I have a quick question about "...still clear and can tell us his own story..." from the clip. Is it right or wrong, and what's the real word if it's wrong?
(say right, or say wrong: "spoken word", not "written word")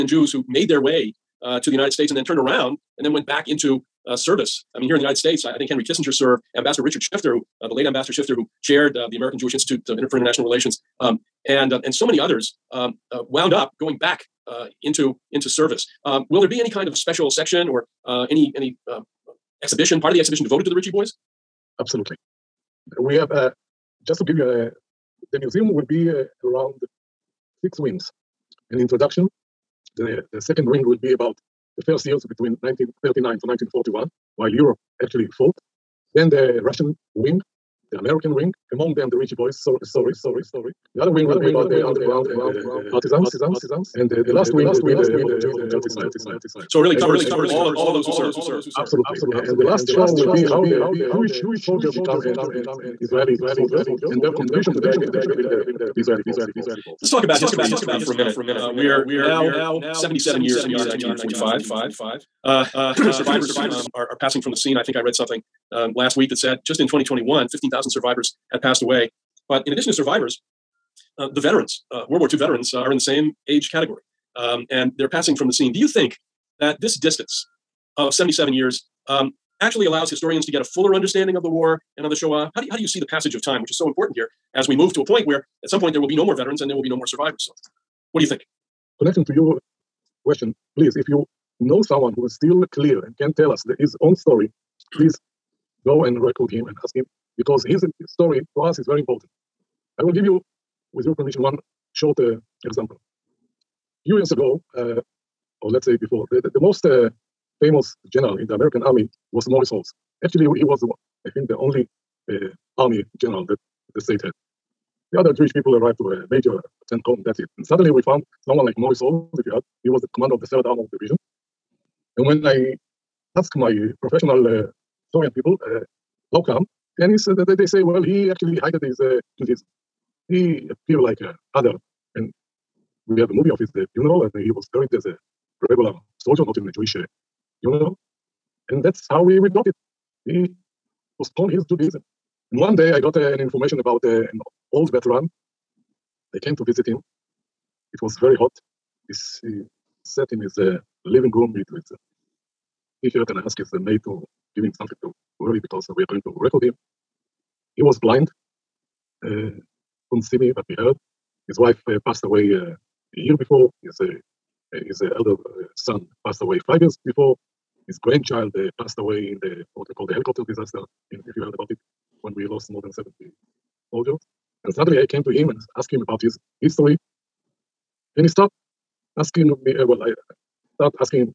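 right.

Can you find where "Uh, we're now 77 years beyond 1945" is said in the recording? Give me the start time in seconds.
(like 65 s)
58 s.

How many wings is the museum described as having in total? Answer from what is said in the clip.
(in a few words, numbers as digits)
6.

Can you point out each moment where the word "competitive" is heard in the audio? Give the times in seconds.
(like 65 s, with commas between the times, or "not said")
not said.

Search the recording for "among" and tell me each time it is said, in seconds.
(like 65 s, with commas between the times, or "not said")
38 s.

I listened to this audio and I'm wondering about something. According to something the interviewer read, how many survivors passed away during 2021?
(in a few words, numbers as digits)
15,000.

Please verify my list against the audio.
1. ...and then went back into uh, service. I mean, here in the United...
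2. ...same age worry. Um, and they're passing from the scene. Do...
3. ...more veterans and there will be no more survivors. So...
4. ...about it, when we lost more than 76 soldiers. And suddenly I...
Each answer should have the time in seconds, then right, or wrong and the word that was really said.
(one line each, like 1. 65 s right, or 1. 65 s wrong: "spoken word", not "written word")
1. 2 s right
2. 72 s wrong: "category", not "worry"
3. 86 s right
4. 171 s wrong: "70", not "76".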